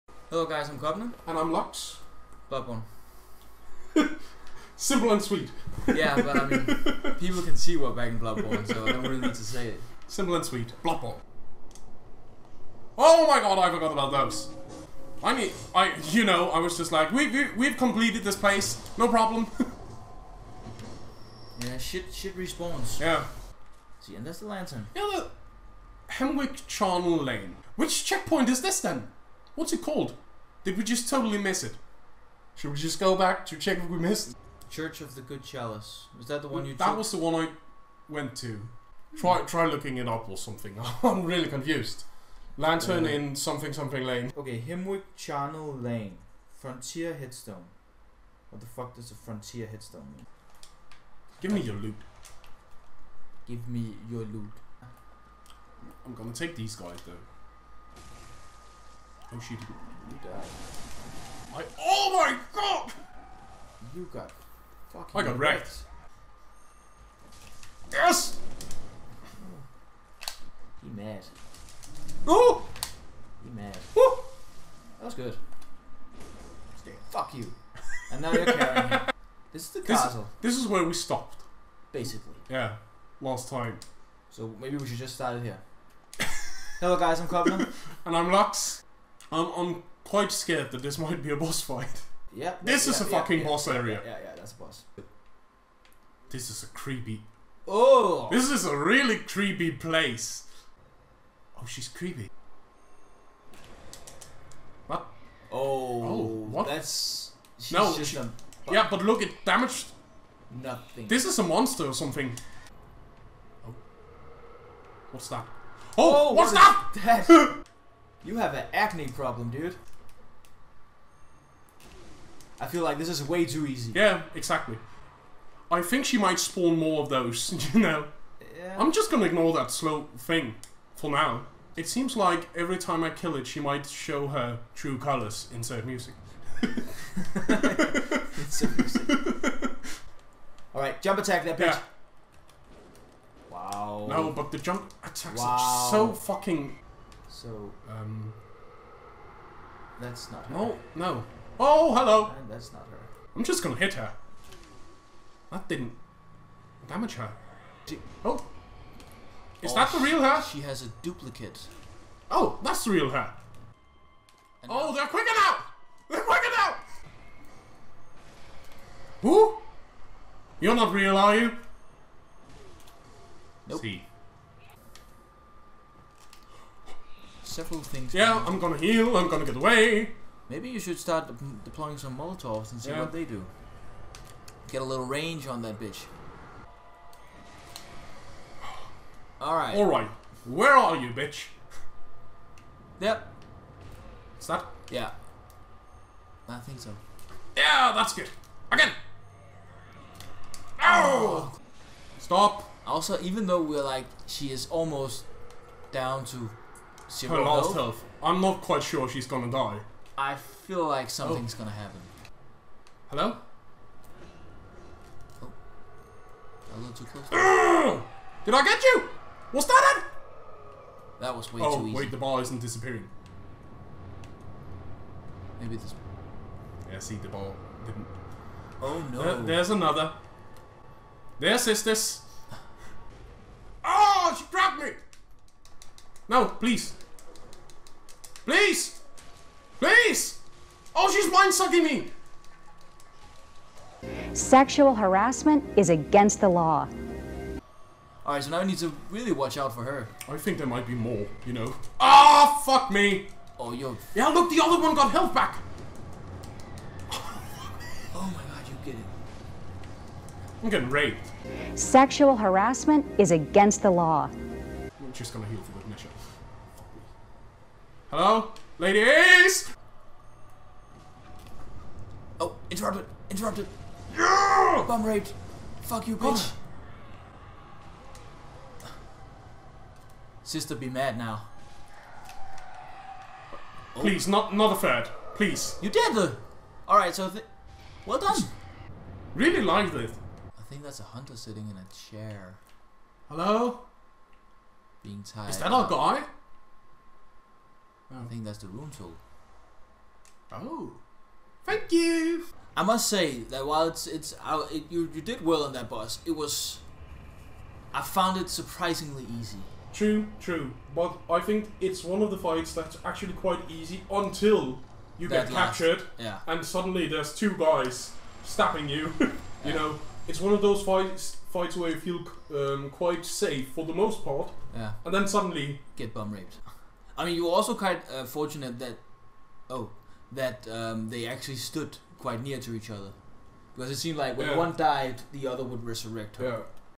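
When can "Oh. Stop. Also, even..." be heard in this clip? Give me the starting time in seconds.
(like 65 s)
200 s.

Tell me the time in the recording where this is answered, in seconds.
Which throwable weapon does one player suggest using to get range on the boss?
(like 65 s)
182 s.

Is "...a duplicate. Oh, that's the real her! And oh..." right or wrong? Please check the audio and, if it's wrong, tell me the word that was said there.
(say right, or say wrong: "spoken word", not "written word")
right.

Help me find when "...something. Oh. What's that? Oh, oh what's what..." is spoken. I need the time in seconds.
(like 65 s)
111 s.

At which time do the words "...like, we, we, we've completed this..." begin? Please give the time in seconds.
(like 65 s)
16 s.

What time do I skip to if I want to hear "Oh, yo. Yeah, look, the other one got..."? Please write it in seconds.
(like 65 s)
253 s.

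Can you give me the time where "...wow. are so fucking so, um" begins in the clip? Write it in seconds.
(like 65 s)
145 s.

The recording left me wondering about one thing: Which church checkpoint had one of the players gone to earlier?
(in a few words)
Church of the Good Chalice.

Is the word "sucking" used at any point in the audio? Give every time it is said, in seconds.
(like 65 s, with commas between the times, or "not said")
241 s.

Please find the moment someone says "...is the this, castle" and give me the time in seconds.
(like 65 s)
79 s.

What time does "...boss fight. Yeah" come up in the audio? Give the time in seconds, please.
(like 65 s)
91 s.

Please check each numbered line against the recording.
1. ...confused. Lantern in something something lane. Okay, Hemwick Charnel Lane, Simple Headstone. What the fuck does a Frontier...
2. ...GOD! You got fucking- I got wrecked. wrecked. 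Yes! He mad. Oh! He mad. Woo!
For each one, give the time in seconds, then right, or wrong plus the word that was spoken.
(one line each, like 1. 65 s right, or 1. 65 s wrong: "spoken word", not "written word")
1. 41 s wrong: "Frontier", not "Simple"
2. 62 s right.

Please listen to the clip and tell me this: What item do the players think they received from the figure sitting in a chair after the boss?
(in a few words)
rune tool.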